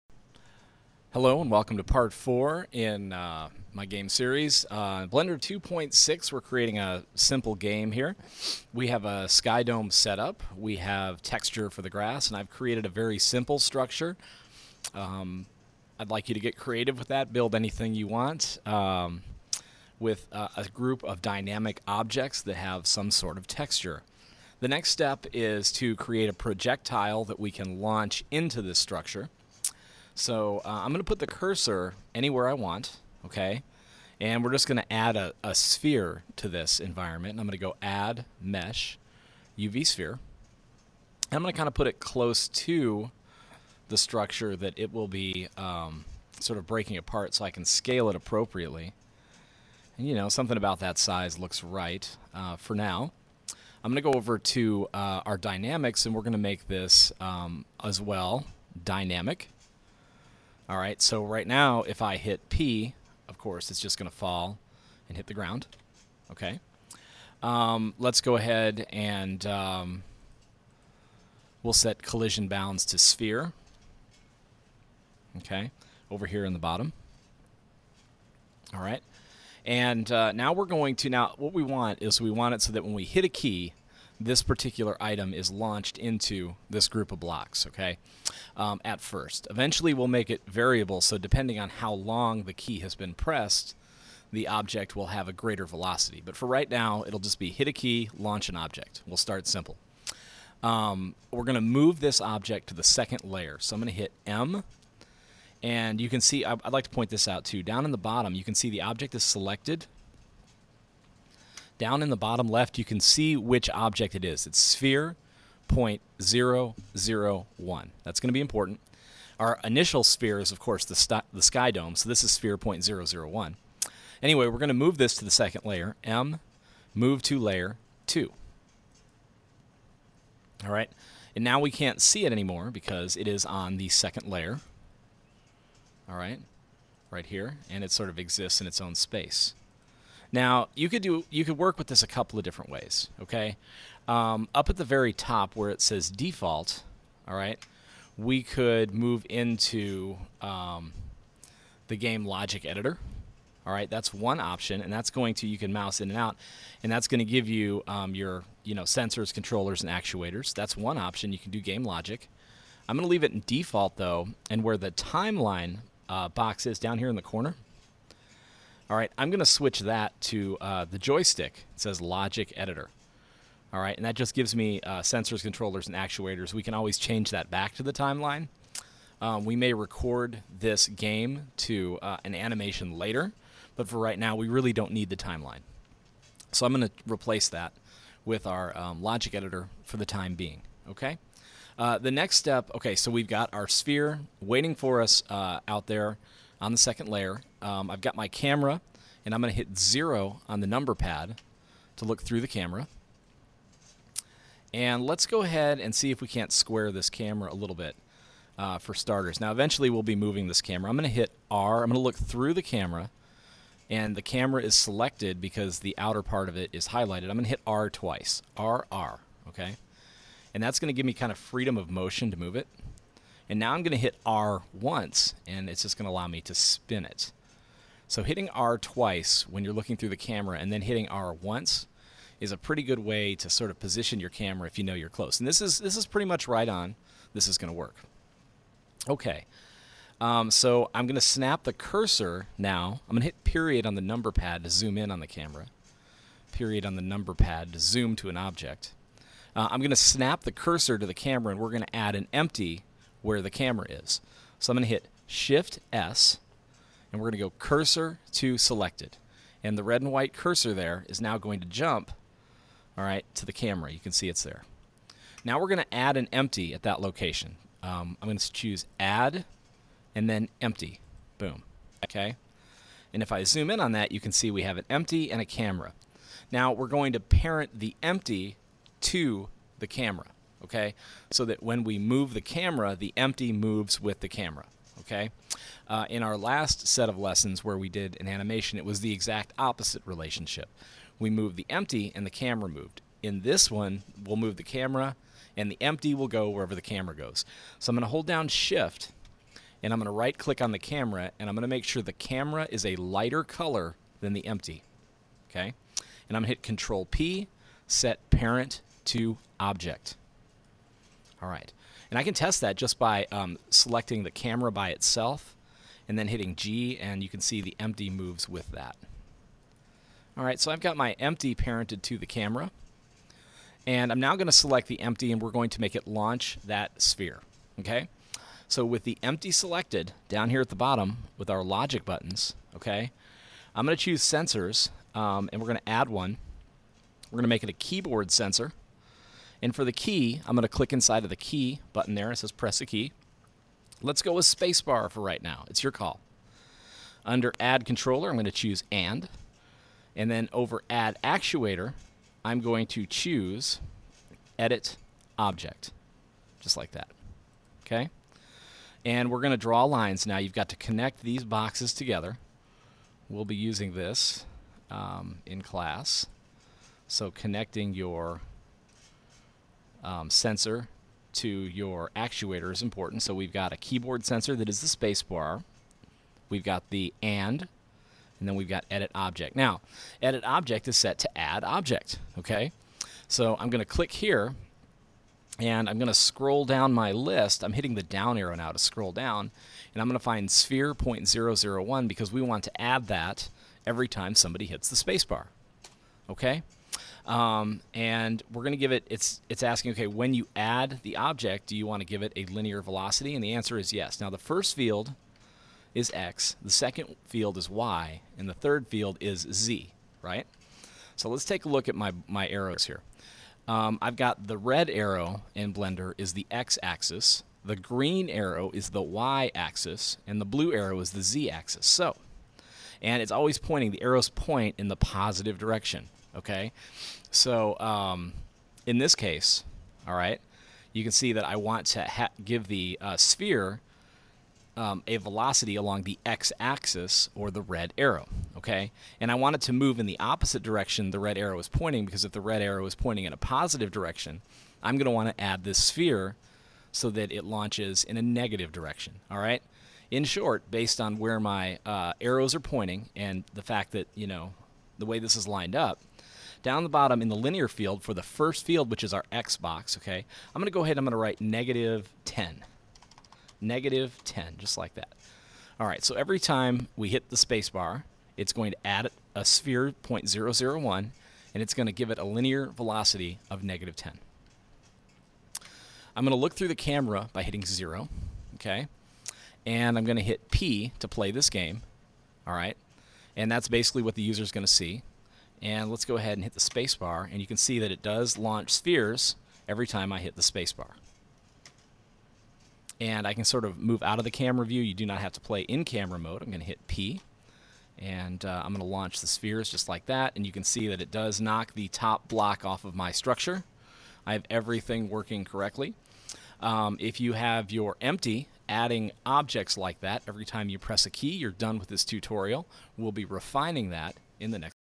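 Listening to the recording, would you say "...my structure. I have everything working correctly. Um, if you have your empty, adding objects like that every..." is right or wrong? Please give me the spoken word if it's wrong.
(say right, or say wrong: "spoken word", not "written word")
right.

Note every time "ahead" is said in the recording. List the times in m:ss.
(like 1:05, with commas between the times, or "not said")
1:08, 3:25, 7:40, 8:06.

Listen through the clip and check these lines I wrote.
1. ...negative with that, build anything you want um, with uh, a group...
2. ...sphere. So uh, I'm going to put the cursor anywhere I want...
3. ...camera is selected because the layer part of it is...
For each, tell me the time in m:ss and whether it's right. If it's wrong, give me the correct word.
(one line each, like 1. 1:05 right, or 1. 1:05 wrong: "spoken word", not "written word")
1. 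0:16 wrong: "creative", not "negative"
2. 0:28 wrong: "structure", not "sphere"
3. 3:34 wrong: "outer", not "layer".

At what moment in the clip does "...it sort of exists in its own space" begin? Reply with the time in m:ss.
2:17.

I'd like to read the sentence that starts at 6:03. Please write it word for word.
We'll be using this um, in class.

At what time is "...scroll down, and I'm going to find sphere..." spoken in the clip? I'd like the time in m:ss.
6:28.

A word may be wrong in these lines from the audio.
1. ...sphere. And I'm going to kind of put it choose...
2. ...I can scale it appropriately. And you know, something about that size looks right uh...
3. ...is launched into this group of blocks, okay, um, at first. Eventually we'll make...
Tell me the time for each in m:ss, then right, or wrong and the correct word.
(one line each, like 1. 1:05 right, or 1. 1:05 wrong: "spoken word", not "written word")
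1. 0:39 wrong: "close", not "choose"
2. 0:47 right
3. 1:25 right.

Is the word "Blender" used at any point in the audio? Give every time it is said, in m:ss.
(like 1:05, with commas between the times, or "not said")
0:05, 6:55.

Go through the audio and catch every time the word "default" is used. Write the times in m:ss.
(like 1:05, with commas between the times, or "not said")
2:26, 2:43.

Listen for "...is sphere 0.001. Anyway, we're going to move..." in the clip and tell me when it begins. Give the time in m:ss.
2:02.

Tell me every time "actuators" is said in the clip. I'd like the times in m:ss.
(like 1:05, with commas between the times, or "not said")
2:39, 2:55, 5:51, 6:12.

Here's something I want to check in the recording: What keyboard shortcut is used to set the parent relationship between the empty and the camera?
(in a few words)
Control P.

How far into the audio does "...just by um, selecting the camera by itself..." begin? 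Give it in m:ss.
5:12.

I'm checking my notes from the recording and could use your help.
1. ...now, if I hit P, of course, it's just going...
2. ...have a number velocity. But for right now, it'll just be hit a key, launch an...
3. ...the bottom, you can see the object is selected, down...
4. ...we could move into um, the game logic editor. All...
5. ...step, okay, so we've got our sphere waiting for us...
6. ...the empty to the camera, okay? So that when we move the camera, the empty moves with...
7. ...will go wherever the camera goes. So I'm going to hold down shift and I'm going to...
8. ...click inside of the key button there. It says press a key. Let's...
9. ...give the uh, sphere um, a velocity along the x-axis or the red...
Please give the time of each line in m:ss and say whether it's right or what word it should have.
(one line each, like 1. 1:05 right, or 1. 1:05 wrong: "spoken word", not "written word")
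1. 1:01 right
2. 1:35 wrong: "greater", not "number"
3. 1:47 right
4. 2:28 right
5. 3:12 right
6. 4:37 right
7. 4:56 right
8. 5:40 right
9. 7:12 right.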